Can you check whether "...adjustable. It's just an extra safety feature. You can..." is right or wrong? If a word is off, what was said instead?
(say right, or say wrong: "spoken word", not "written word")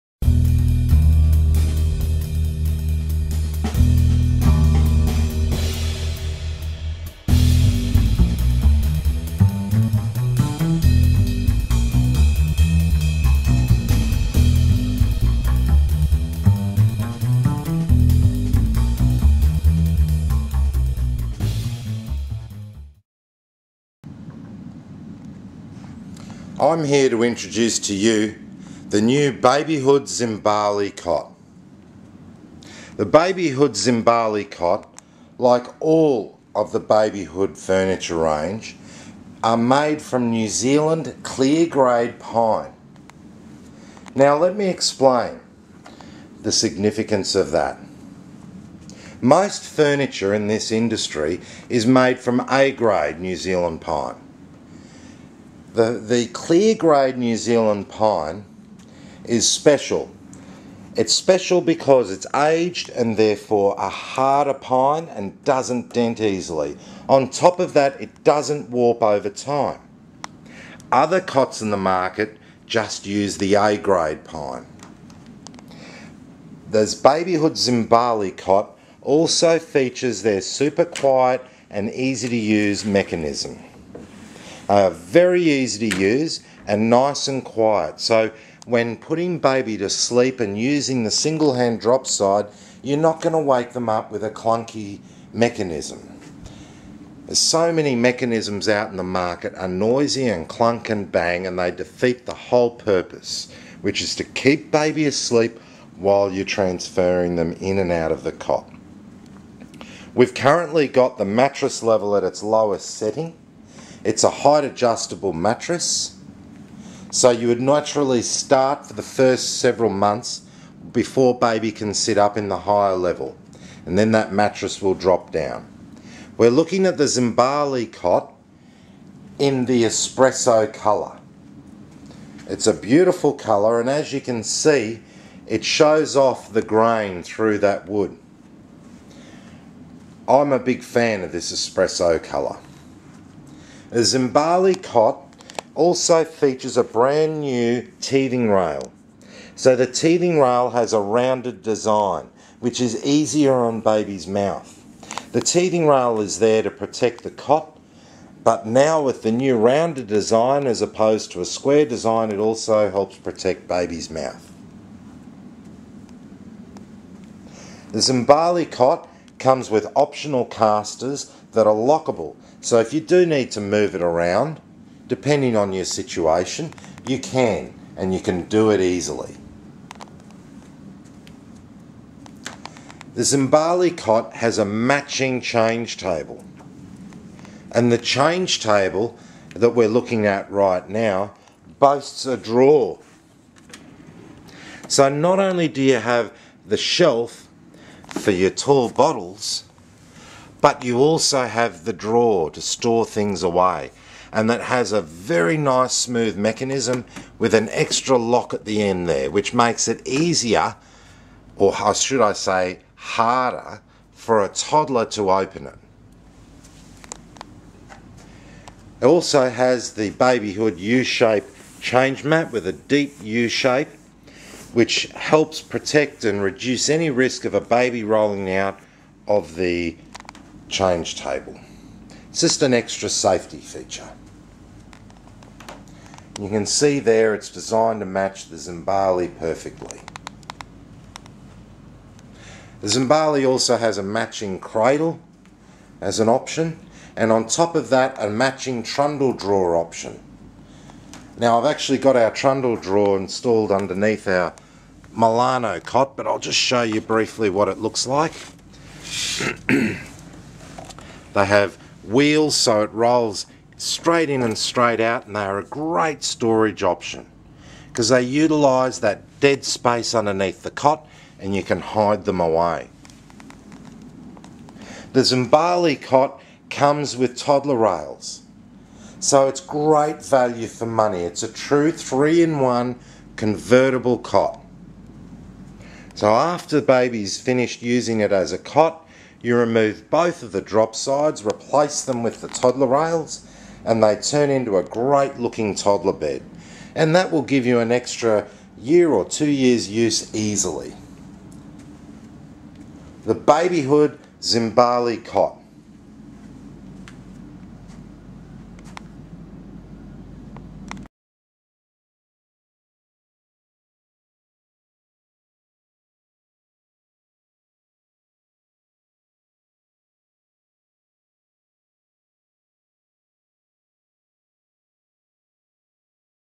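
wrong: "table", not "adjustable".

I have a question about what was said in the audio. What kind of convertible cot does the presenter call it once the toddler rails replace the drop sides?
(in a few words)
Three-in-one.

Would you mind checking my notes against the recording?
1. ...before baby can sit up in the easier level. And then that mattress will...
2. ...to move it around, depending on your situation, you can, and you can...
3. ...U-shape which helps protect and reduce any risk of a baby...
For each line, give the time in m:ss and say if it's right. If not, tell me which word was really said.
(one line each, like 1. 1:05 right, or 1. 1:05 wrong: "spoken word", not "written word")
1. 2:00 wrong: "higher", not "easier"
2. 2:53 right
3. 3:43 right.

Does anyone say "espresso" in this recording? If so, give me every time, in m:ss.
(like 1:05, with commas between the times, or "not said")
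2:09, 2:21.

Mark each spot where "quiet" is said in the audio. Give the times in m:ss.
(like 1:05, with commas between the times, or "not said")
1:20, 1:27.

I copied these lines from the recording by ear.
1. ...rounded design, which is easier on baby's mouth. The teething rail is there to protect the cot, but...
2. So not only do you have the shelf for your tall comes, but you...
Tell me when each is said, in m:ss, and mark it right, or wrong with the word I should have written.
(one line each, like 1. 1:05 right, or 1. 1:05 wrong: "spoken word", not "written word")
1. 2:31 right
2. 3:14 wrong: "bottles", not "comes".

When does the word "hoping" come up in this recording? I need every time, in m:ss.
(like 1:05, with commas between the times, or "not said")
not said.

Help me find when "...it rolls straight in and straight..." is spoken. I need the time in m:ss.
4:22.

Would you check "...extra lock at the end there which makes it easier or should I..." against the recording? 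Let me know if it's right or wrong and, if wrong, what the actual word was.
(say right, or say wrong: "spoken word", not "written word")
right.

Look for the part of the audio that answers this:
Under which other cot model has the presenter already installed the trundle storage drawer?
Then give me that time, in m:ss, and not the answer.
4:15.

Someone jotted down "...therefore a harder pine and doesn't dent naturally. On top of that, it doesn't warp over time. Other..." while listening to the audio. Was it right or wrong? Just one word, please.
wrong.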